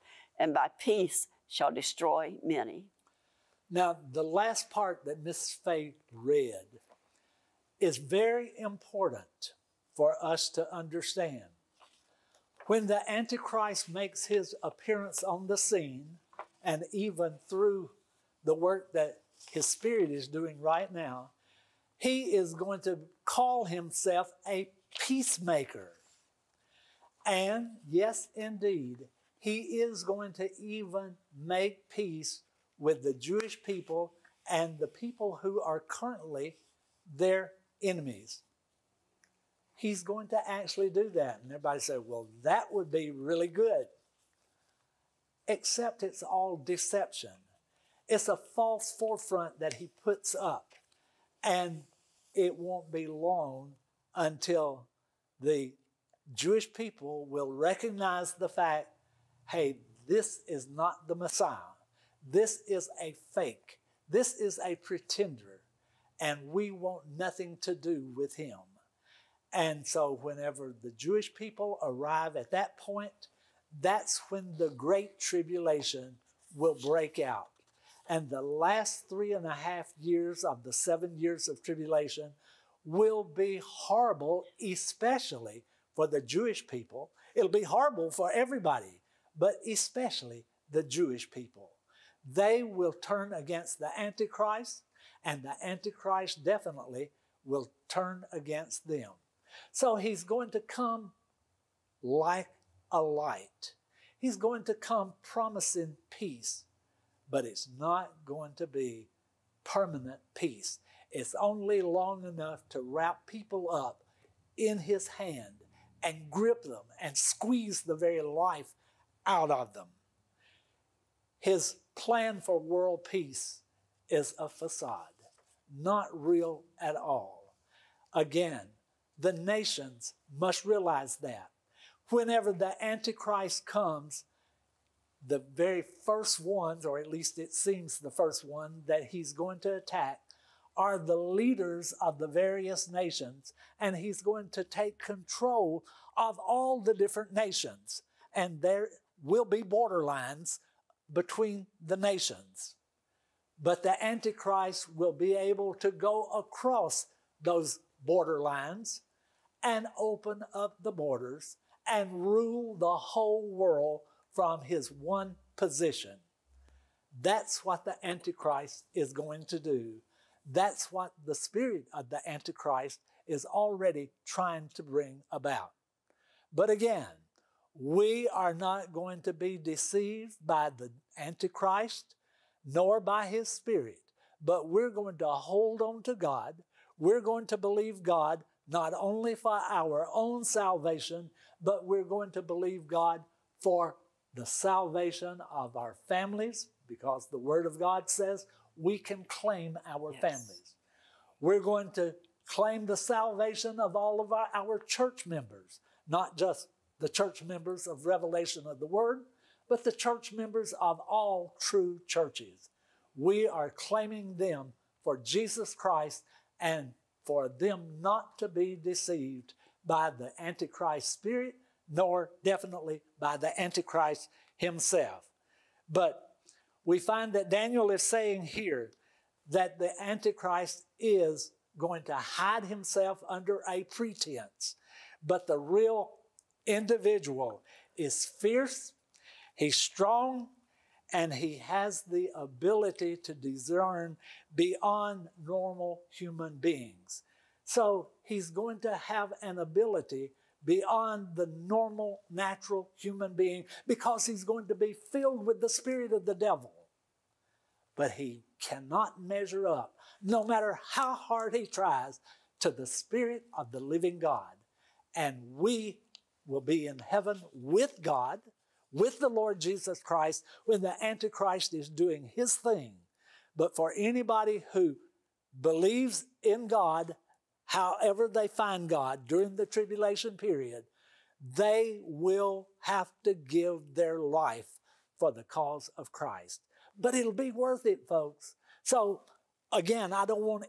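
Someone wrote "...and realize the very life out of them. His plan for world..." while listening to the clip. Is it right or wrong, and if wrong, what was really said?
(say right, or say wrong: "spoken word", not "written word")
wrong: "squeeze", not "realize".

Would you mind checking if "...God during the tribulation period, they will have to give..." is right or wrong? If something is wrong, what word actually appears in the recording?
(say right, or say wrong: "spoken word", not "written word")
right.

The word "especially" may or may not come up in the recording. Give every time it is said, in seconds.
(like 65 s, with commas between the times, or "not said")
84 s, 89 s.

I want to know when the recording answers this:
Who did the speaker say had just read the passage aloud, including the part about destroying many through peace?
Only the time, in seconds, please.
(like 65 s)
5 s.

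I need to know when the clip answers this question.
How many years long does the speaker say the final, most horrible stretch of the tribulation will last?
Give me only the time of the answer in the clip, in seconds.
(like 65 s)
79 s.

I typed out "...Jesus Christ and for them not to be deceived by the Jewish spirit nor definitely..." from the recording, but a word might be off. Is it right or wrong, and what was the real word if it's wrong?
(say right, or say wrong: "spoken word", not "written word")
wrong: "Antichrist", not "Jewish".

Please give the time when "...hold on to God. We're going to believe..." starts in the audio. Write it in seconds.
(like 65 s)
185 s.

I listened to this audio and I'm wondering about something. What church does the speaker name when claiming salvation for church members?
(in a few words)
Revelation of the Word.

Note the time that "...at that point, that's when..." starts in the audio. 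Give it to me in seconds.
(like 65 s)
72 s.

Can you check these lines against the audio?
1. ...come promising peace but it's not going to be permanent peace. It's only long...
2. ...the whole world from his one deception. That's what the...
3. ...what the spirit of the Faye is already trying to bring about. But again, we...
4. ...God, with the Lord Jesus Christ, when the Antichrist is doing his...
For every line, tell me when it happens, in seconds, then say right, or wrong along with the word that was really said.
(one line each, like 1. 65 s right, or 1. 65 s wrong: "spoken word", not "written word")
1. 104 s right
2. 162 s wrong: "position", not "deception"
3. 170 s wrong: "Antichrist", not "Faye"
4. 268 s right.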